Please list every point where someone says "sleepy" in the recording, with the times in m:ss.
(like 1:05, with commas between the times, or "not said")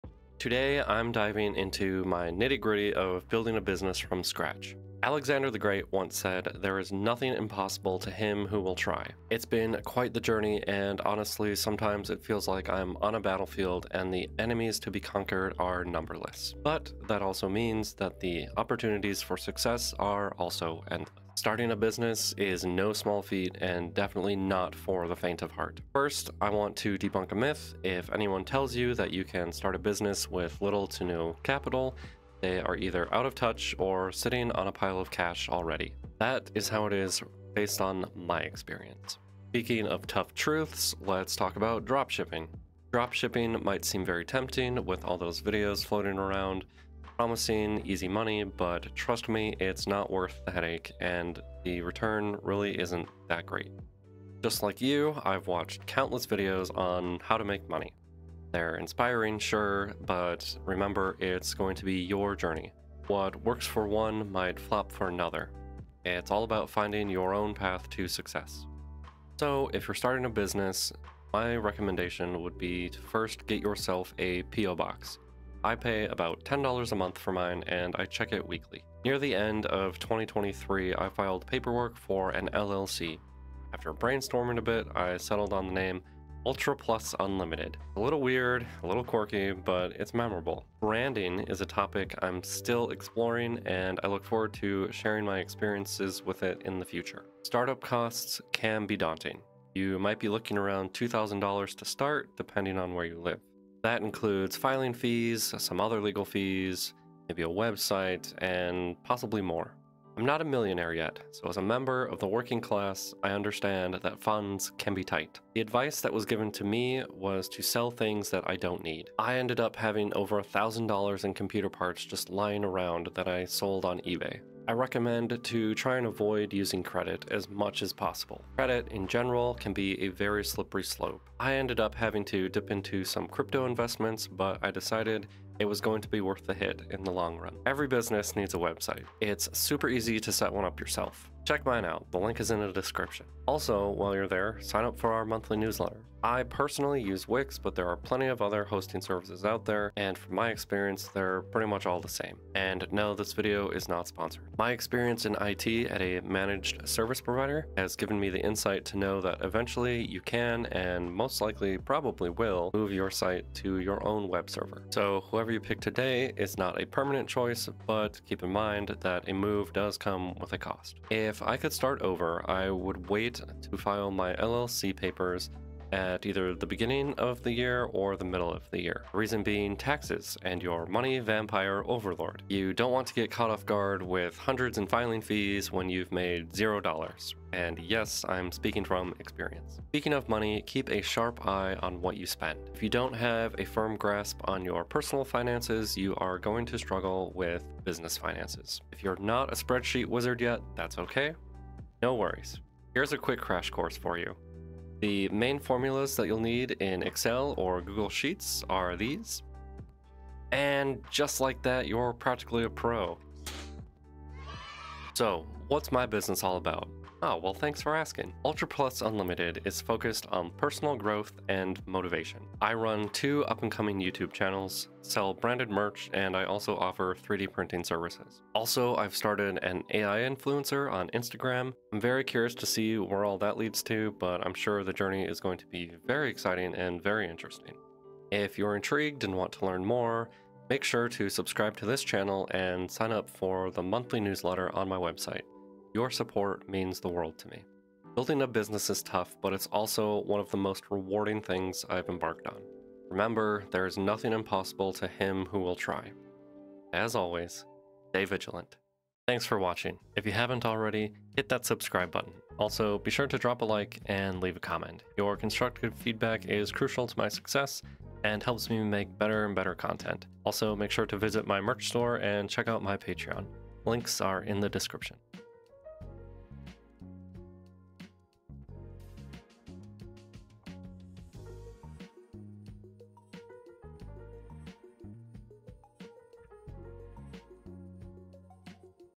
not said.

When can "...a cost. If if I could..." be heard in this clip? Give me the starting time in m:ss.
2:50.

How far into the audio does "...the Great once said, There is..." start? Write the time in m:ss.
0:05.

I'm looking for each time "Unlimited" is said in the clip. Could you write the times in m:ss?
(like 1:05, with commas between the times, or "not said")
1:27, 3:39.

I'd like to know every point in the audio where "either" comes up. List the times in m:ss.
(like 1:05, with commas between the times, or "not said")
0:32, 2:56.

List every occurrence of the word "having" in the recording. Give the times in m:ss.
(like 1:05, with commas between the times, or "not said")
1:59, 2:11.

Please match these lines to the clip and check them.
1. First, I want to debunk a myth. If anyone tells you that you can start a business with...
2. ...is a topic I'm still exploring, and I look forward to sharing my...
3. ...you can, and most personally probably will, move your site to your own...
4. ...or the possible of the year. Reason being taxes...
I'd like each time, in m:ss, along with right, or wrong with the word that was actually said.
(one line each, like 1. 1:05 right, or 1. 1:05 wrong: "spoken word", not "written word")
1. 0:25 right
2. 1:31 right
3. 2:40 wrong: "likely", not "personally"
4. 2:57 wrong: "middle", not "possible".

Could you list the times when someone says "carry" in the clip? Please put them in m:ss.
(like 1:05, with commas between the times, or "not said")
not said.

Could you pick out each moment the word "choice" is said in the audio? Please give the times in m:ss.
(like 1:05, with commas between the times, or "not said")
2:47.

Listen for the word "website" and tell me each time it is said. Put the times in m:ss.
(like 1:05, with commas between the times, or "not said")
1:47, 2:18, 4:04.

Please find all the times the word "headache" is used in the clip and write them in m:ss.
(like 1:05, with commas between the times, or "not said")
0:50.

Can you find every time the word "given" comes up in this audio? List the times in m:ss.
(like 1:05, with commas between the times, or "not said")
1:56, 2:37.